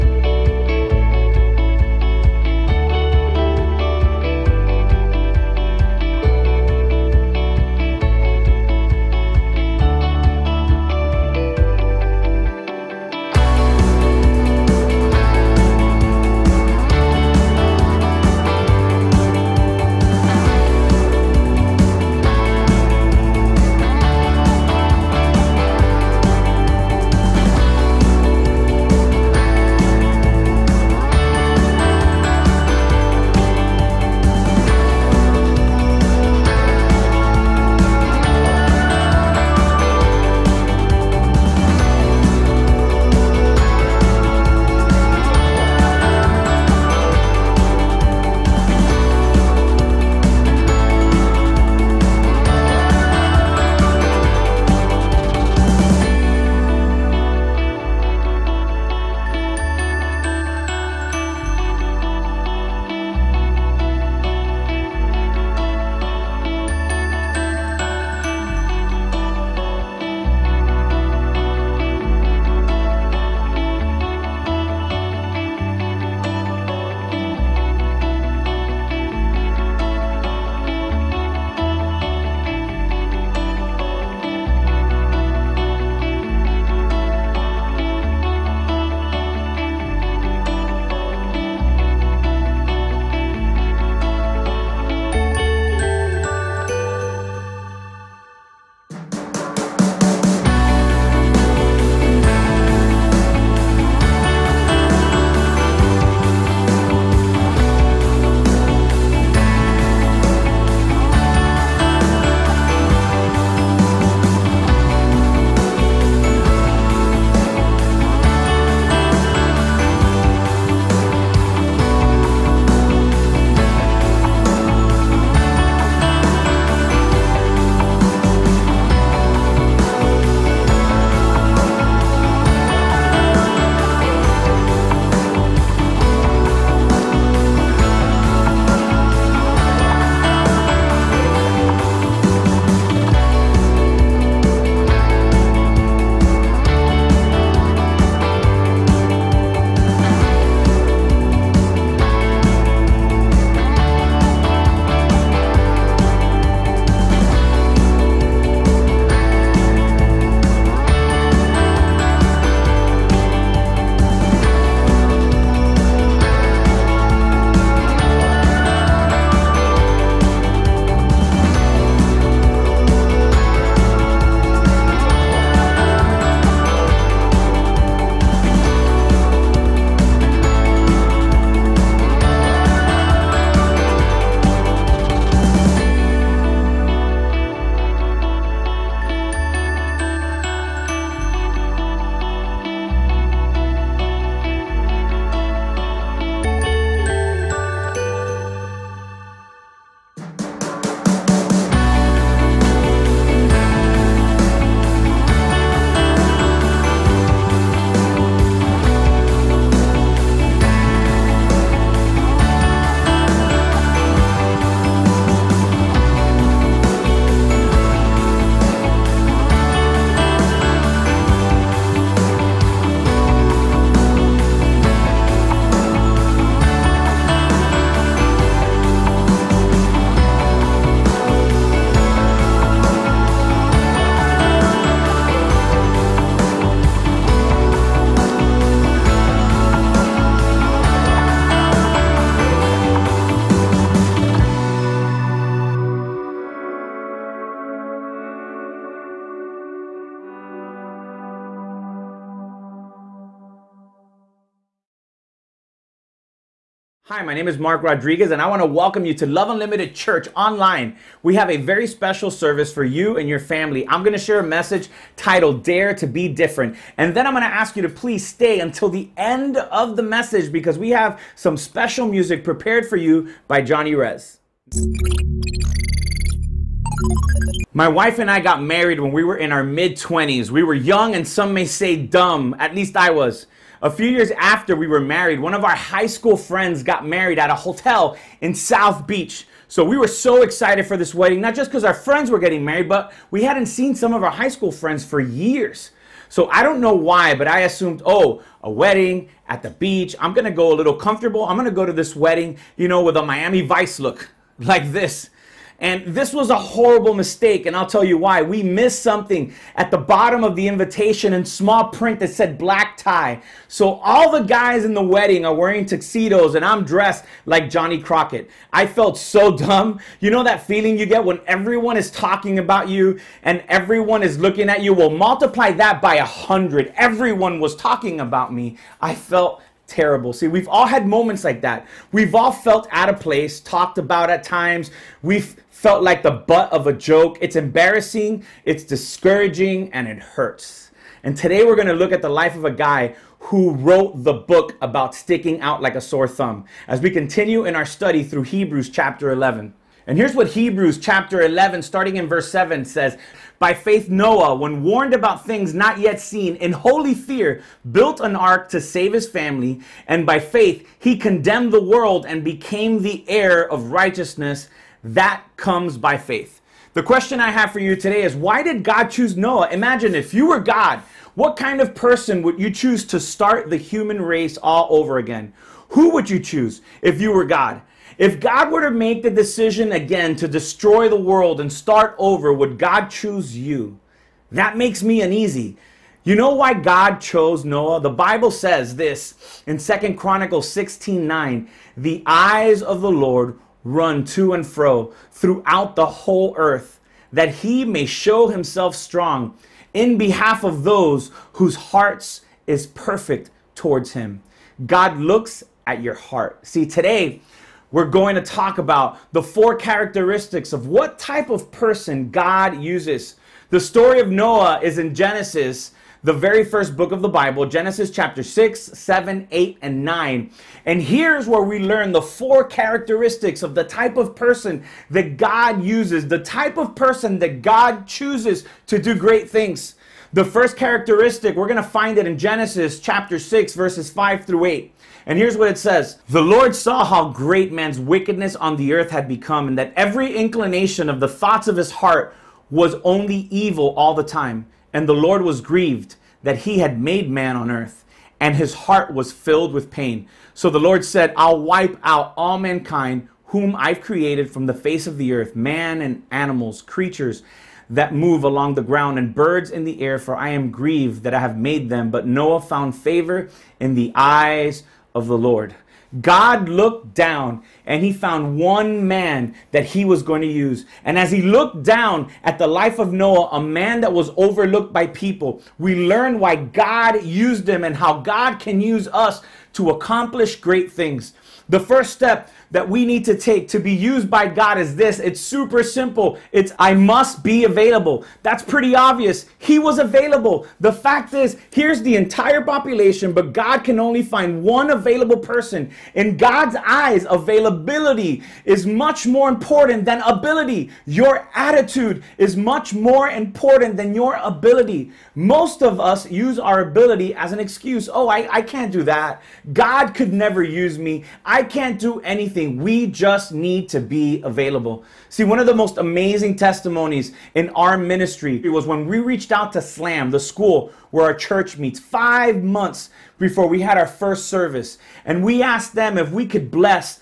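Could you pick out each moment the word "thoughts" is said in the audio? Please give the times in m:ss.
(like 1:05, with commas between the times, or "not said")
7:21.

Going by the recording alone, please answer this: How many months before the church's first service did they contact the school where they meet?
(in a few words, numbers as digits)
5.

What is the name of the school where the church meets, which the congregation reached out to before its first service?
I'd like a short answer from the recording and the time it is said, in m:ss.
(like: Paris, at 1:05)
SLAM, at 8:39.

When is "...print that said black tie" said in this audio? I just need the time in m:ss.
5:11.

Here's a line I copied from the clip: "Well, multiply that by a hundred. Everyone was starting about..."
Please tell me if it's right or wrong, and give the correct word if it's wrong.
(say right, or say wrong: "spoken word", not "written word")
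wrong: "talking", not "starting".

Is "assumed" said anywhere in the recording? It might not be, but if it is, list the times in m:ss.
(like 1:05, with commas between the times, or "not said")
4:57.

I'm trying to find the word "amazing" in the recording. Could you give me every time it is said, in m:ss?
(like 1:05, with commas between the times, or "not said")
8:35.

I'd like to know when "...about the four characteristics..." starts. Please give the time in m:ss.
6:48.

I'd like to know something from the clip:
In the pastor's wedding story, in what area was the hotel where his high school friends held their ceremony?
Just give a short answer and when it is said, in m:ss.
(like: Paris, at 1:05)
South Beach, at 4:48.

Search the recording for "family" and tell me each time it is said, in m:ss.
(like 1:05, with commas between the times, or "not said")
4:23, 5:59.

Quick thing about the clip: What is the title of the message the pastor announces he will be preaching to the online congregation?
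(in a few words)
Dare to Be Different.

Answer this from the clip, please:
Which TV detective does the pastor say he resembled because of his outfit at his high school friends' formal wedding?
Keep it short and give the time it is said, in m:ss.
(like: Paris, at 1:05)
Johnny Crockett, at 5:17.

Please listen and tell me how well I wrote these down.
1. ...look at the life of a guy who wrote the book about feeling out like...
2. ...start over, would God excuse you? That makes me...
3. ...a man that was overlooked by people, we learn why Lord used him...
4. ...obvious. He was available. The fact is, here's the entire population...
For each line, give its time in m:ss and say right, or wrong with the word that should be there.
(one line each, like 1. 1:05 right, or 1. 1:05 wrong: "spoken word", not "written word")
1. 5:41 wrong: "sticking", not "feeling"
2. 6:21 wrong: "choose", not "excuse"
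3. 7:53 wrong: "God", not "Lord"
4. 8:08 right.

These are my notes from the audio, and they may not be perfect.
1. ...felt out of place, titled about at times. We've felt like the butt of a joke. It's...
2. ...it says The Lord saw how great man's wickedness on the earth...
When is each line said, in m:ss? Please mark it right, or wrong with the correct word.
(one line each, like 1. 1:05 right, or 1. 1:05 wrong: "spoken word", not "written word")
1. 5:32 wrong: "talked", not "titled"
2. 7:15 right.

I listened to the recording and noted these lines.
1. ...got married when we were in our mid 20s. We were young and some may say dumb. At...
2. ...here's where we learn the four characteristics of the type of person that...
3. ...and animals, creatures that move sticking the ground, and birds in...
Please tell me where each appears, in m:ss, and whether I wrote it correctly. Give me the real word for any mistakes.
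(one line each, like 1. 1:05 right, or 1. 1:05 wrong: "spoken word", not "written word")
1. 4:38 right
2. 7:01 right
3. 7:36 wrong: "along", not "sticking".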